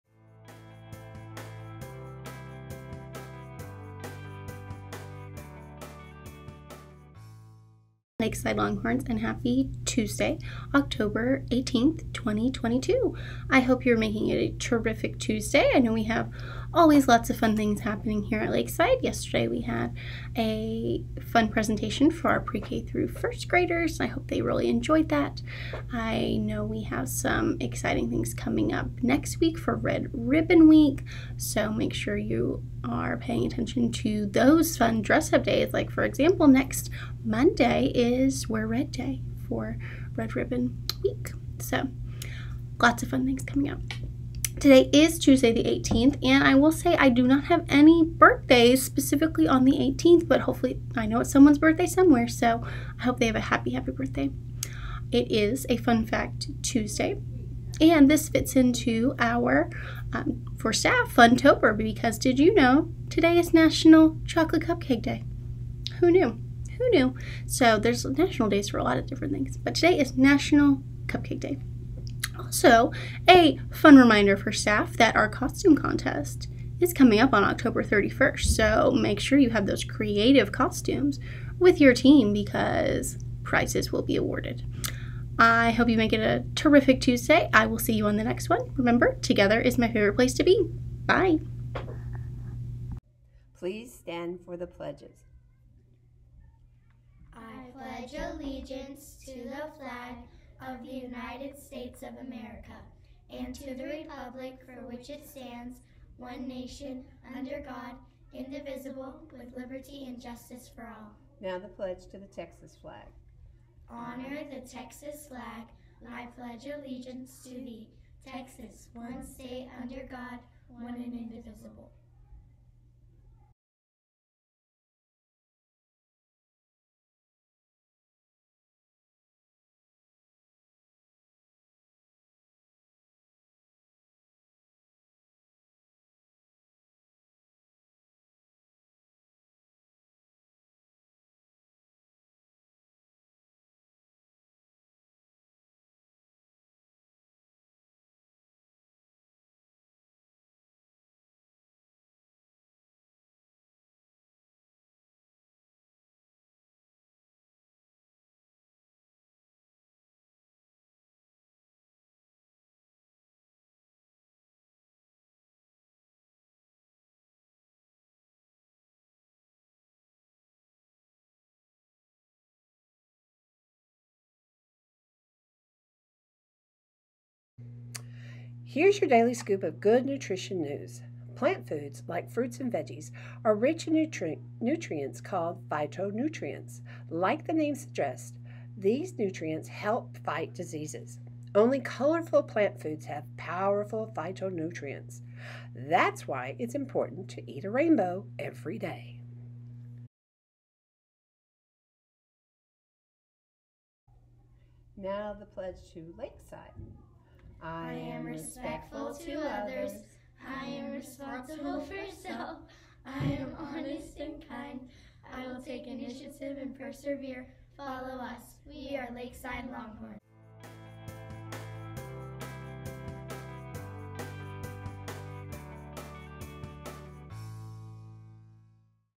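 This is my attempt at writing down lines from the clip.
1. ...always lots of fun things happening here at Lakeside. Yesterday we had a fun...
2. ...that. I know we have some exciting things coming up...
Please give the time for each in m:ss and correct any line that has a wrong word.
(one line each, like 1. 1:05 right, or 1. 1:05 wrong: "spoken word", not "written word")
1. 0:16 right
2. 0:25 right.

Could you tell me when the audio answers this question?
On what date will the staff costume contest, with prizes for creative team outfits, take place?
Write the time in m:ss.
1:17.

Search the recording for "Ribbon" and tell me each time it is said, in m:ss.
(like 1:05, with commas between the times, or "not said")
0:30, 0:40.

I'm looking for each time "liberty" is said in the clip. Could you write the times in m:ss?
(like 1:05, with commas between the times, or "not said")
1:49.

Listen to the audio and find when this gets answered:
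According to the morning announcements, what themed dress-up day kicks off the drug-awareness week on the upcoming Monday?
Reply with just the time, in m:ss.
0:38.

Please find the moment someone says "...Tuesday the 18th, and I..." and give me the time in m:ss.
0:45.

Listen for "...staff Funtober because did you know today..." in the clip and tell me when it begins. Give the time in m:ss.
1:00.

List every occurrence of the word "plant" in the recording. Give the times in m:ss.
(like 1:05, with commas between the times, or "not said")
3:01, 3:12.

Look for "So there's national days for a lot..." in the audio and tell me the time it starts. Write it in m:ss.
1:07.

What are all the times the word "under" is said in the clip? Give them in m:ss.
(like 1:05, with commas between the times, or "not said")
1:47, 1:59.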